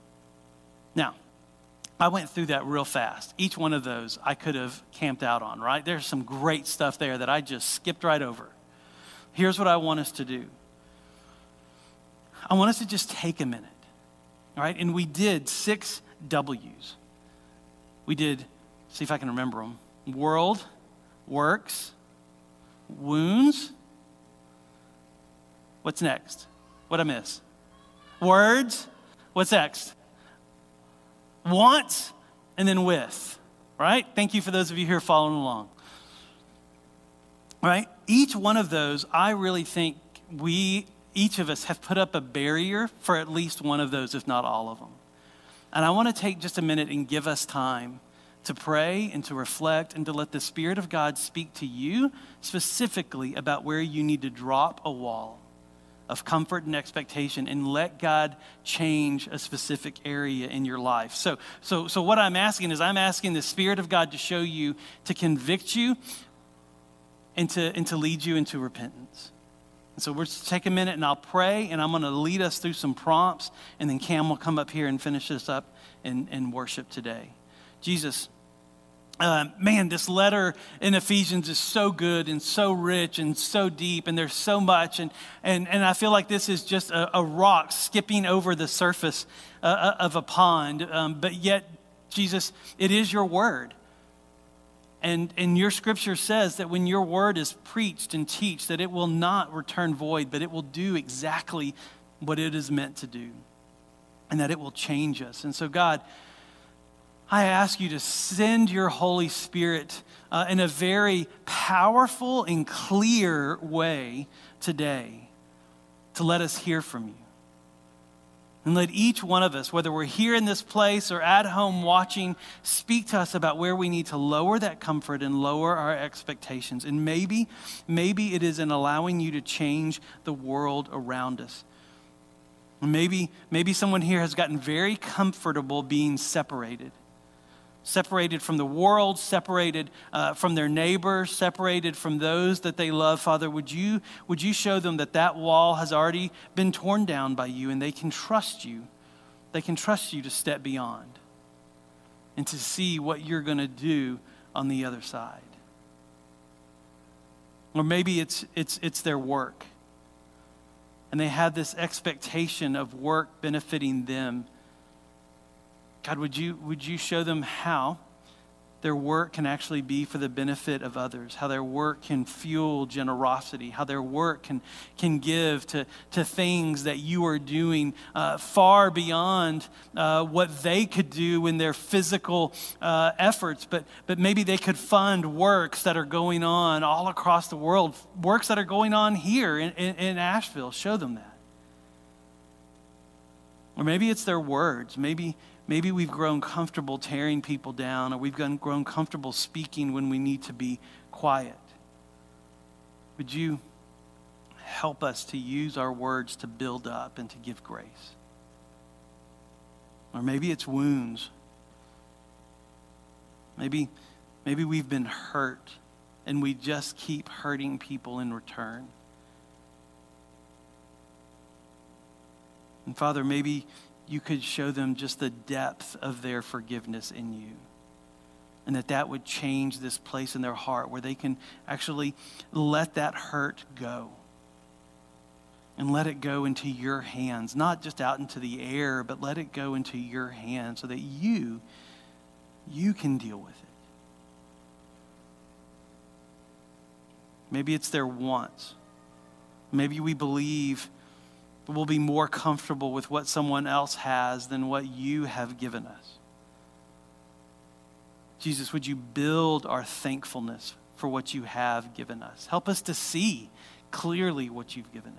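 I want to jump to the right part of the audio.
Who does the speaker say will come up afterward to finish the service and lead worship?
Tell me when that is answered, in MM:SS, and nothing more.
01:13.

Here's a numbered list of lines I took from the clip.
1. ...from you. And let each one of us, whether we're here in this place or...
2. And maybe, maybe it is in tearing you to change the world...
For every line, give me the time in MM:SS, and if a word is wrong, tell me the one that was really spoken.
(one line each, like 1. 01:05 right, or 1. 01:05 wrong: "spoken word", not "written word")
1. 01:56 right
2. 02:06 wrong: "allowing", not "tearing".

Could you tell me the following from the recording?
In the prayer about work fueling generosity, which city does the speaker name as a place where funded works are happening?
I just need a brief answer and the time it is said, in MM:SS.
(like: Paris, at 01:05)
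Asheville, at 03:10.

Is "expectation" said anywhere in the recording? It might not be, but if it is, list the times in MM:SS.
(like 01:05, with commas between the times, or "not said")
00:56, 02:05, 02:41.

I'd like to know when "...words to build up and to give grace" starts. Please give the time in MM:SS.
03:25.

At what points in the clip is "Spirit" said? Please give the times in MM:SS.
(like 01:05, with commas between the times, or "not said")
00:50, 01:03, 01:49.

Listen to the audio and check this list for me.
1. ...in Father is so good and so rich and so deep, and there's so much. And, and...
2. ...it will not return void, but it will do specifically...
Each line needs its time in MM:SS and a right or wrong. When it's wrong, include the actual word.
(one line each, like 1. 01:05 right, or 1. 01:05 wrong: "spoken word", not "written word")
1. 01:20 wrong: "Ephesians", not "Father"
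2. 01:38 wrong: "exactly", not "specifically".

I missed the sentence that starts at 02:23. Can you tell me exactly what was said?
Father, would you, would you show them that that wall has already been torn down by you and they can trust you?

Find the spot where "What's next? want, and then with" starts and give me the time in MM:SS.
00:29.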